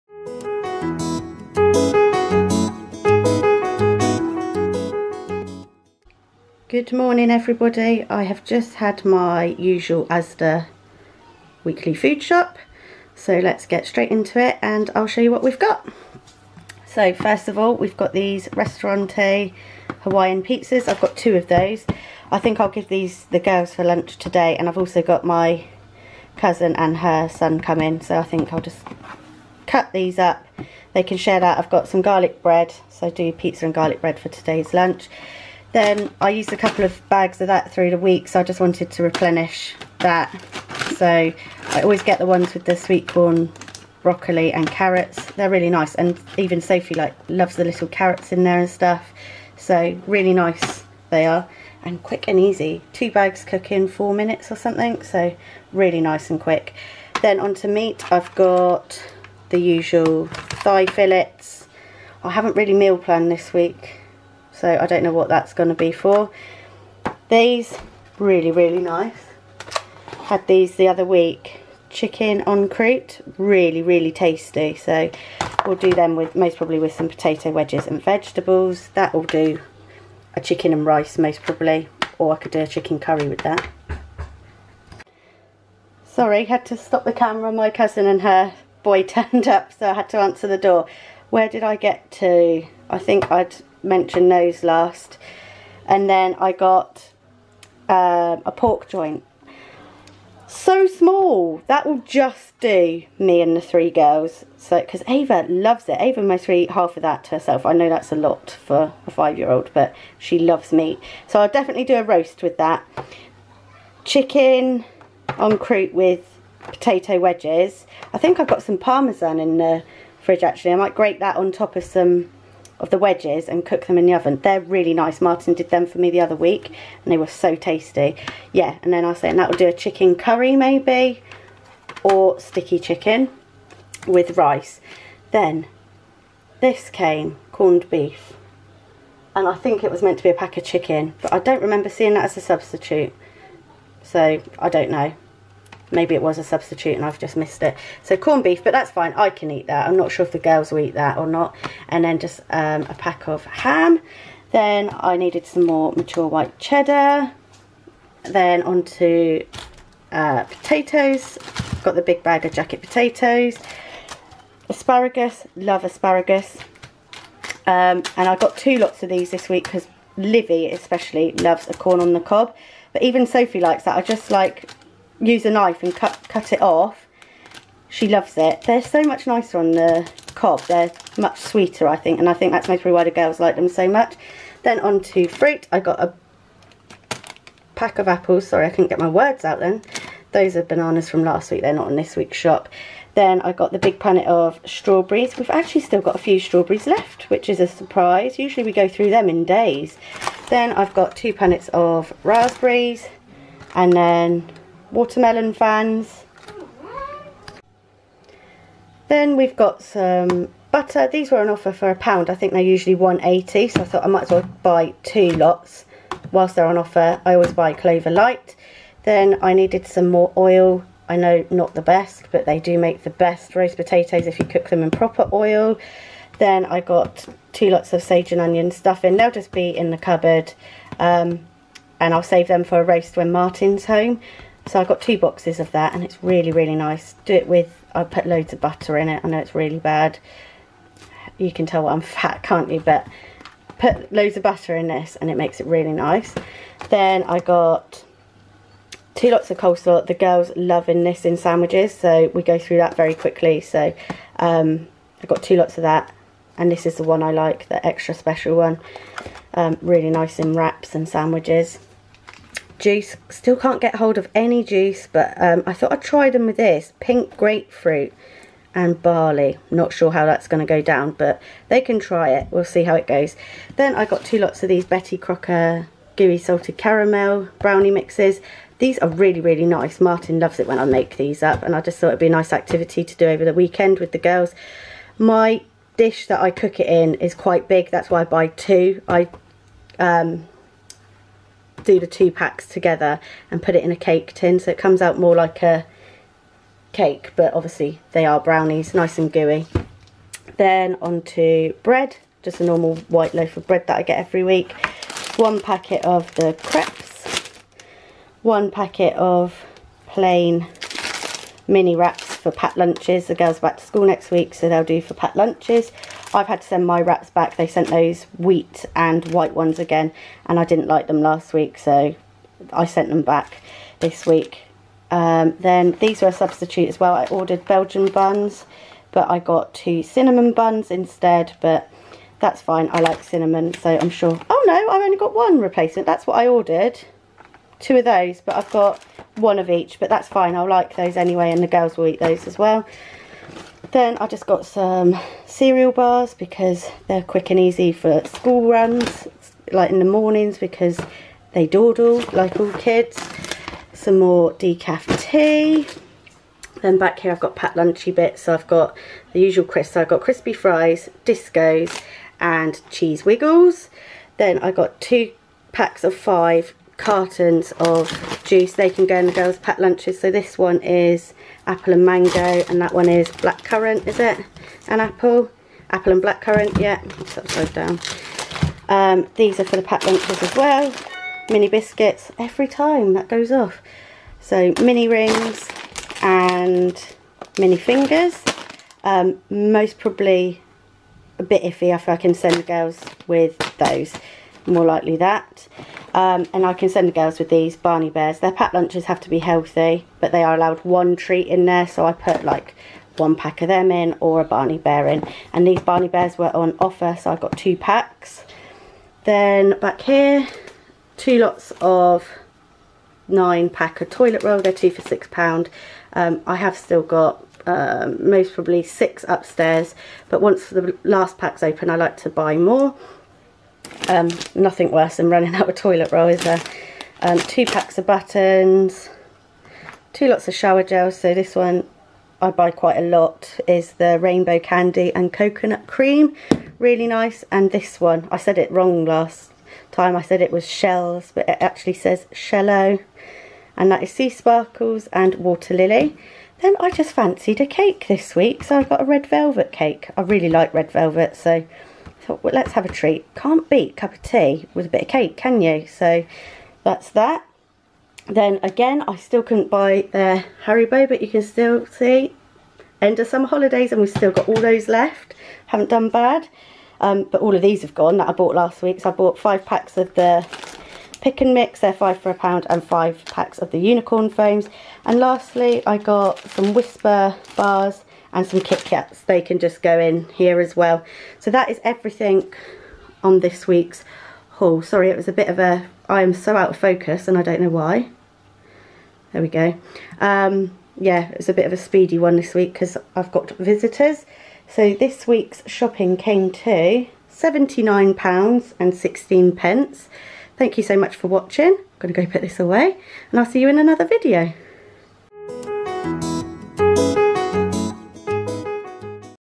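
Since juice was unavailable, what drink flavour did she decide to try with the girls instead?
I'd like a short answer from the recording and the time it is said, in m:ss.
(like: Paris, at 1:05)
Pink grapefruit and barley, at 4:26.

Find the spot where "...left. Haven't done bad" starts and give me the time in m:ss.
7:44.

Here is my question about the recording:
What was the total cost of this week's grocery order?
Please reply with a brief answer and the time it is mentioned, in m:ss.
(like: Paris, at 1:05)
£79.16, at 8:17.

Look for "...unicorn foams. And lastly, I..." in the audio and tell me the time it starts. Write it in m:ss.
7:53.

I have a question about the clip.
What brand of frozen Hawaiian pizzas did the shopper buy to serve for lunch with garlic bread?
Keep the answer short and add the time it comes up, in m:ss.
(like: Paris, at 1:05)
Ristorante, at 0:18.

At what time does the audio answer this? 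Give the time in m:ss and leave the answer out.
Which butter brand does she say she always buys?
3:37.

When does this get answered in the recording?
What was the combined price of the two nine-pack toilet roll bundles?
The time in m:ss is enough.
6:55.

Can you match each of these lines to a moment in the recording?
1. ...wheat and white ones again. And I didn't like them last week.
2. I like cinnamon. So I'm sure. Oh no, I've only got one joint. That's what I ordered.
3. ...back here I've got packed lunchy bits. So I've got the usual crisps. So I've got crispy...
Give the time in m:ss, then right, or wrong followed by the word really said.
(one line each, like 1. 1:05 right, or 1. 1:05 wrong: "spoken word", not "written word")
1. 5:18 right
2. 5:32 wrong: "replacement", not "joint"
3. 5:56 right.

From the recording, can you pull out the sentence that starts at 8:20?
Thank you so much for watching.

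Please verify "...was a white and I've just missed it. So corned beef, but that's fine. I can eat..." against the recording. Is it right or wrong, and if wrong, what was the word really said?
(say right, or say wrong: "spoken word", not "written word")
wrong: "substitute", not "white".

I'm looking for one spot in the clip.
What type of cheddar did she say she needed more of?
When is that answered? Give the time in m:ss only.
2:35.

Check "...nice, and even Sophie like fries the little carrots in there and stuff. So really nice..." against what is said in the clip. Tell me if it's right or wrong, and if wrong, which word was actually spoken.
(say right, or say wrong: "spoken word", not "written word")
wrong: "loves", not "fries".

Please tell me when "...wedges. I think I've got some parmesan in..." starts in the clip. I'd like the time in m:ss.
1:57.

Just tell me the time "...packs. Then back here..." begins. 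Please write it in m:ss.
6:47.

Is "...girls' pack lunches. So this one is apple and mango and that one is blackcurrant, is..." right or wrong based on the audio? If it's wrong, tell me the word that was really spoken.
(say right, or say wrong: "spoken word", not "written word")
right.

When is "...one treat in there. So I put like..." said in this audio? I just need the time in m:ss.
6:40.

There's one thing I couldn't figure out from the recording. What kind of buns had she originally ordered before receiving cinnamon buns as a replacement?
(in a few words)
Belgian buns.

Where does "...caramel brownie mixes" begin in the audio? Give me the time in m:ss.
4:36.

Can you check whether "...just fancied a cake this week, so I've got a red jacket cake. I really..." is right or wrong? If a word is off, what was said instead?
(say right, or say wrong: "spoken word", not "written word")
wrong: "velvet", not "jacket".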